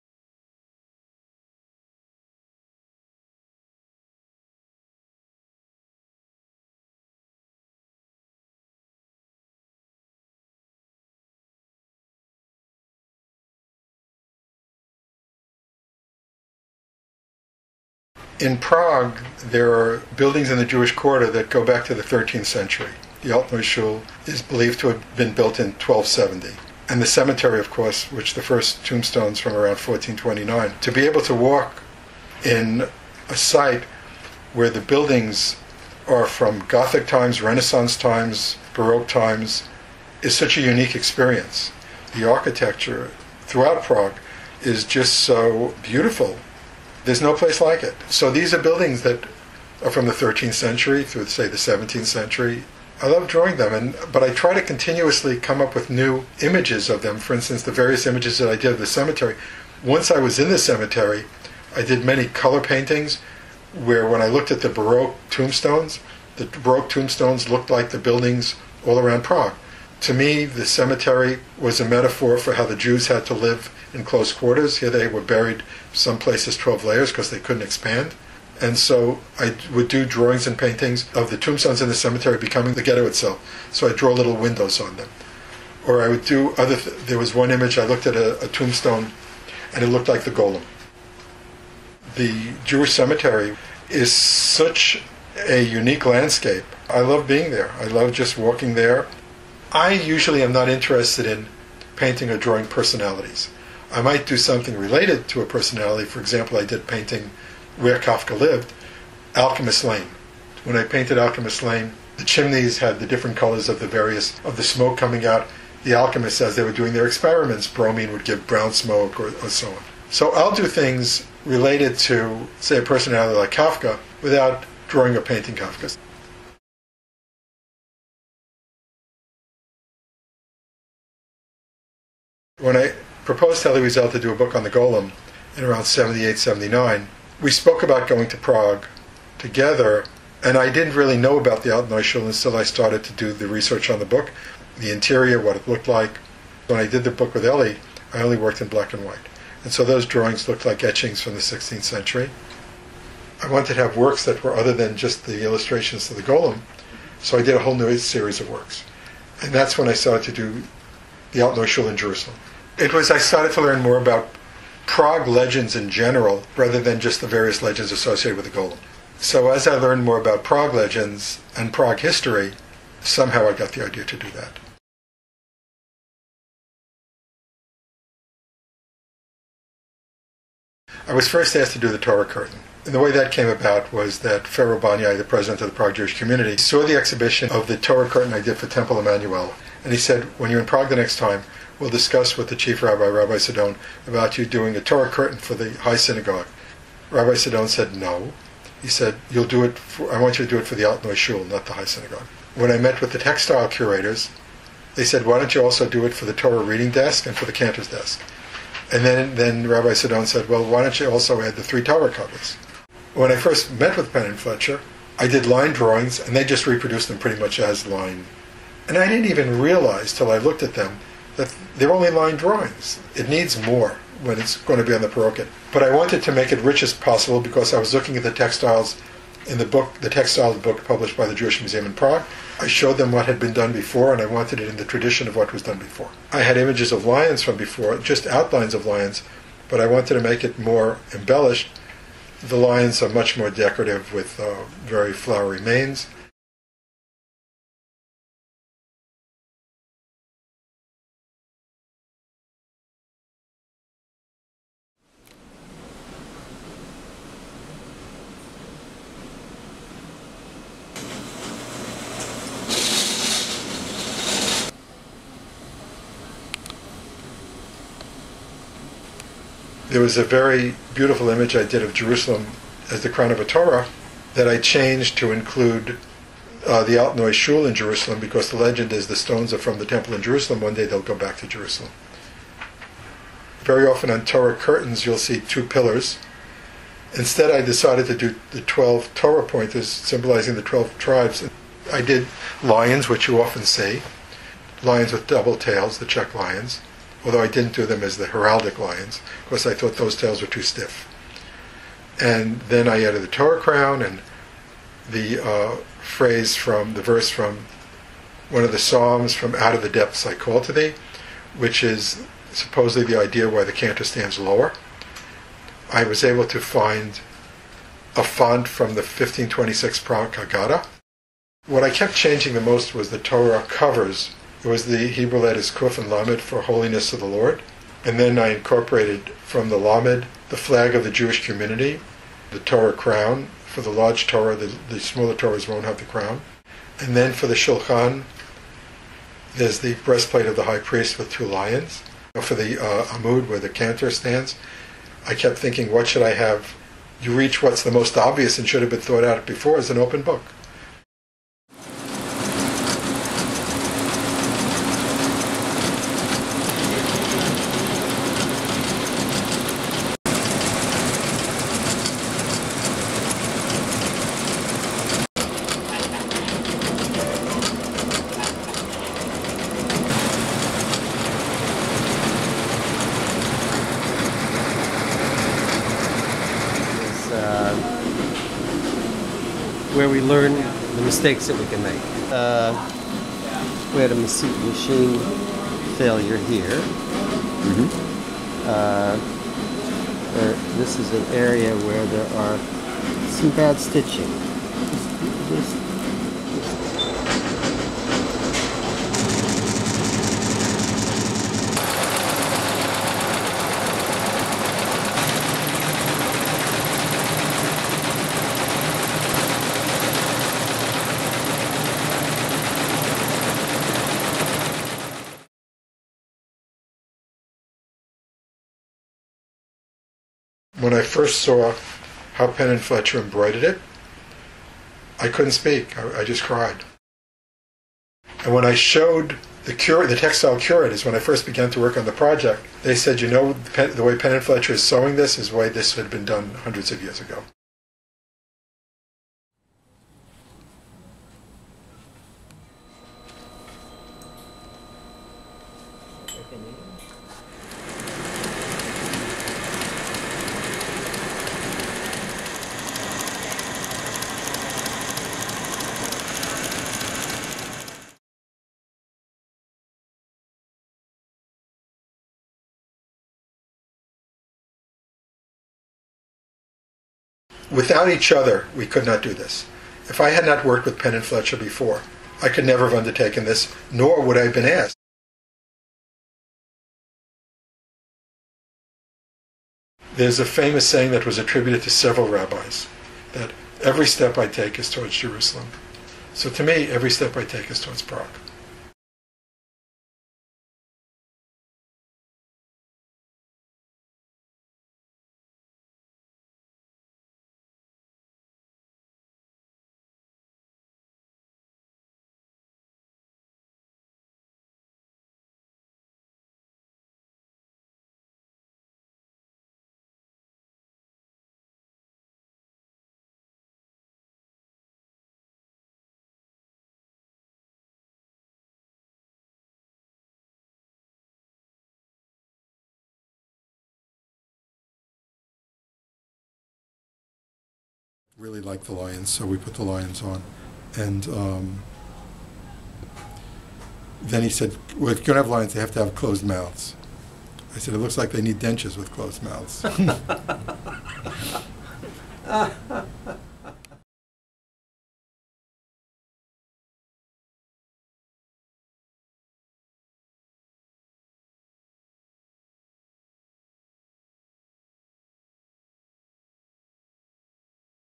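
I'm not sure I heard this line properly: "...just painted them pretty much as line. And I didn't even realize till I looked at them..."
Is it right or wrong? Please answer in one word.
wrong.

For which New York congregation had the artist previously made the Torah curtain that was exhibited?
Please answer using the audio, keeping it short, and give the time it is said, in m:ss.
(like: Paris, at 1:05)
Temple Emanu-El, at 3:08.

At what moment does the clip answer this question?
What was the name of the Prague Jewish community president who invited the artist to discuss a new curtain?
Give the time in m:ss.
3:04.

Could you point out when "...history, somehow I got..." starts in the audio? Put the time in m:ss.
2:51.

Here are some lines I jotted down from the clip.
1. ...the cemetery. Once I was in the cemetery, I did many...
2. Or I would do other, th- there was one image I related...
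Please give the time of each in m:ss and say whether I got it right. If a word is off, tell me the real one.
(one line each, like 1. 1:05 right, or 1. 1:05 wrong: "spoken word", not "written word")
1. 0:58 right
2. 1:25 wrong: "looked", not "related".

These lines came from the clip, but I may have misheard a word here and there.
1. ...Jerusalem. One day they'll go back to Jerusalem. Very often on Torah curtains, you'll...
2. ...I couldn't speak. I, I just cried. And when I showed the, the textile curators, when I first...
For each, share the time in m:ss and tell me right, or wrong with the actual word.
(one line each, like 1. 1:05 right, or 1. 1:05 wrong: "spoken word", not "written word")
1. 4:40 right
2. 7:05 right.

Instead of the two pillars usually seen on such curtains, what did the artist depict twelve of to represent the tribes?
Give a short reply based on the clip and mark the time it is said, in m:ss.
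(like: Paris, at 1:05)
Torah pointers, at 4:49.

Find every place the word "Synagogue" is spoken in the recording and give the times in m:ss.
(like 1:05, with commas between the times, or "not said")
3:15, 3:21.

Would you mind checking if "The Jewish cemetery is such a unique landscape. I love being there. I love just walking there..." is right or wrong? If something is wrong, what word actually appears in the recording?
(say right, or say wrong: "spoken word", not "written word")
right.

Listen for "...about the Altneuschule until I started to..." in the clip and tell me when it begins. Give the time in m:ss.
2:21.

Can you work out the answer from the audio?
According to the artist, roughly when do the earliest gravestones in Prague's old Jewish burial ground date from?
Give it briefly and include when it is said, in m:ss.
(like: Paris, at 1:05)
1429, at 0:29.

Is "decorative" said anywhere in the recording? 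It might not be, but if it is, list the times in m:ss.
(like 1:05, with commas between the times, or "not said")
4:03.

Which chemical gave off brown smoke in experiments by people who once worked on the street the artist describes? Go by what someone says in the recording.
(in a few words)
Bromine.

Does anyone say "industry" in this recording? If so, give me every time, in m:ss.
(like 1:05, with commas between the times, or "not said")
not said.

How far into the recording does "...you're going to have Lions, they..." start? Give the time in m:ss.
8:55.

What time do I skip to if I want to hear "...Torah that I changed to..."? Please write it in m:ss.
4:33.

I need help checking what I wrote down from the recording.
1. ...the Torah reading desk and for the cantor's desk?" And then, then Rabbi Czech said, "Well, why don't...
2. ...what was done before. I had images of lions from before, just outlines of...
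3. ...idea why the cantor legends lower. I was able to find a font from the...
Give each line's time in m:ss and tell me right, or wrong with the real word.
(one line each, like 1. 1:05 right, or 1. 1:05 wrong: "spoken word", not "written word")
1. 3:26 wrong: "Sidon", not "Czech"
2. 3:55 right
3. 5:13 wrong: "stands", not "legends".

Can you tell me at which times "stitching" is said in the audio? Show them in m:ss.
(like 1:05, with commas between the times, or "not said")
6:33.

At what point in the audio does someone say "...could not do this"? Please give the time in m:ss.
7:48.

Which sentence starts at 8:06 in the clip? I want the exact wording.
So to me, every step I take is towards Prague.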